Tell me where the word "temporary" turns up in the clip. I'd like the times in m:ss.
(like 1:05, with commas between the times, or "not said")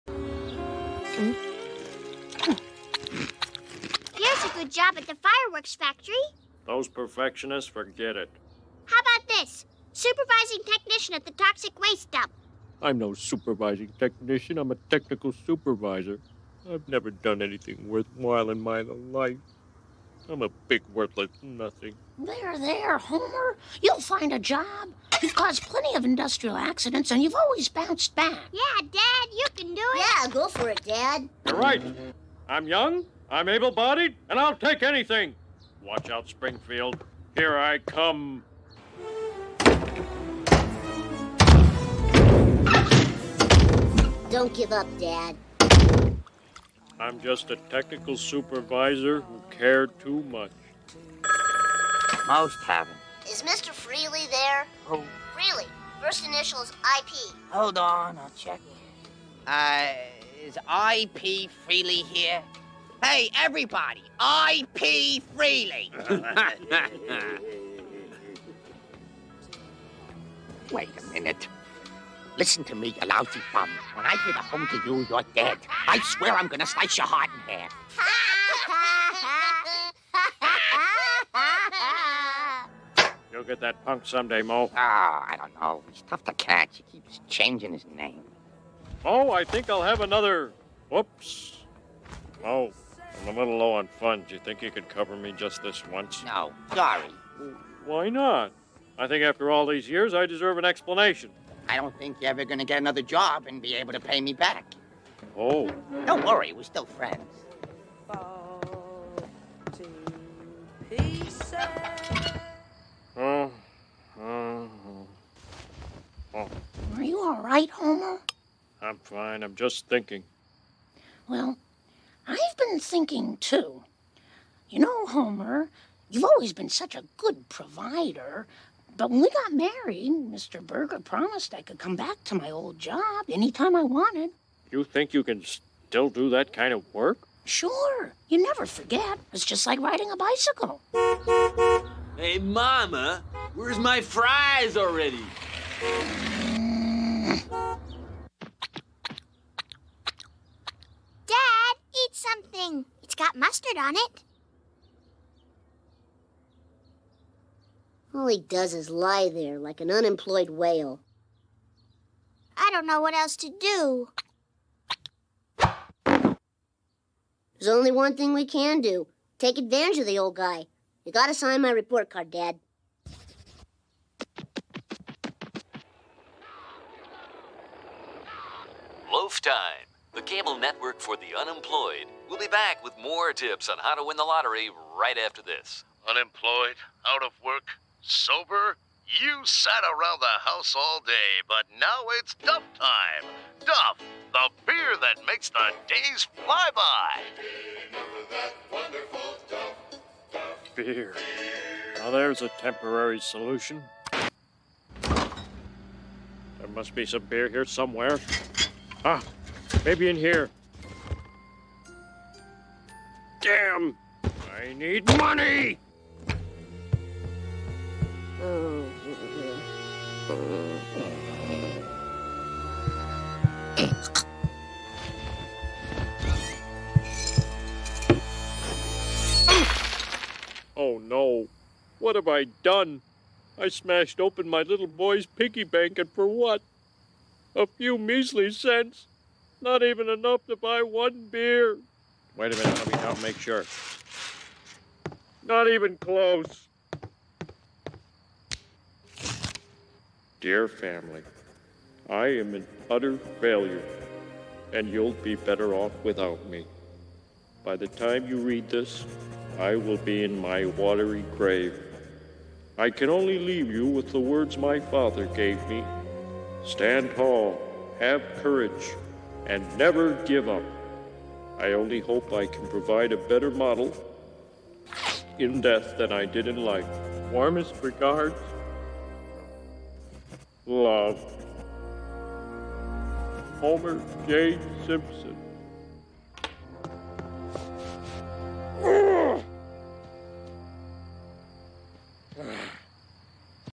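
3:22.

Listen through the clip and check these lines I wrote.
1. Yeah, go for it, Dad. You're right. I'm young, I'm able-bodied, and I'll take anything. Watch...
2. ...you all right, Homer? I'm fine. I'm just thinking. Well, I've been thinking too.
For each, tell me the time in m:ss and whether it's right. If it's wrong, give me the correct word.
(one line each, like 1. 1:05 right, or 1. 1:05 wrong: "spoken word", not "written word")
1. 0:30 right
2. 1:57 right.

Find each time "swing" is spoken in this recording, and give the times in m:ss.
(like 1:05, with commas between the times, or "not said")
not said.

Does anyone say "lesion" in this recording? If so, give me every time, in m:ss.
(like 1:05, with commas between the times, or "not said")
not said.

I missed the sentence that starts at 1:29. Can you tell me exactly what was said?
Oh, I think I'll have another.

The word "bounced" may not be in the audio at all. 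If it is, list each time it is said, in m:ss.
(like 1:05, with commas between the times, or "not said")
0:27.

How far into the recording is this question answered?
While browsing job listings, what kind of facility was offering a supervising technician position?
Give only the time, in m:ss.
0:11.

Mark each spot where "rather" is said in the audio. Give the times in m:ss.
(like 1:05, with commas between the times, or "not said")
not said.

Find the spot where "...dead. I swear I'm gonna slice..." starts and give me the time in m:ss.
1:15.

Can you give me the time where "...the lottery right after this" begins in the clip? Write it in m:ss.
3:04.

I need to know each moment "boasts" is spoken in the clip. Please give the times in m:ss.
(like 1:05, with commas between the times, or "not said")
not said.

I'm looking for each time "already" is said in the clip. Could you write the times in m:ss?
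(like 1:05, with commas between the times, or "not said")
2:24.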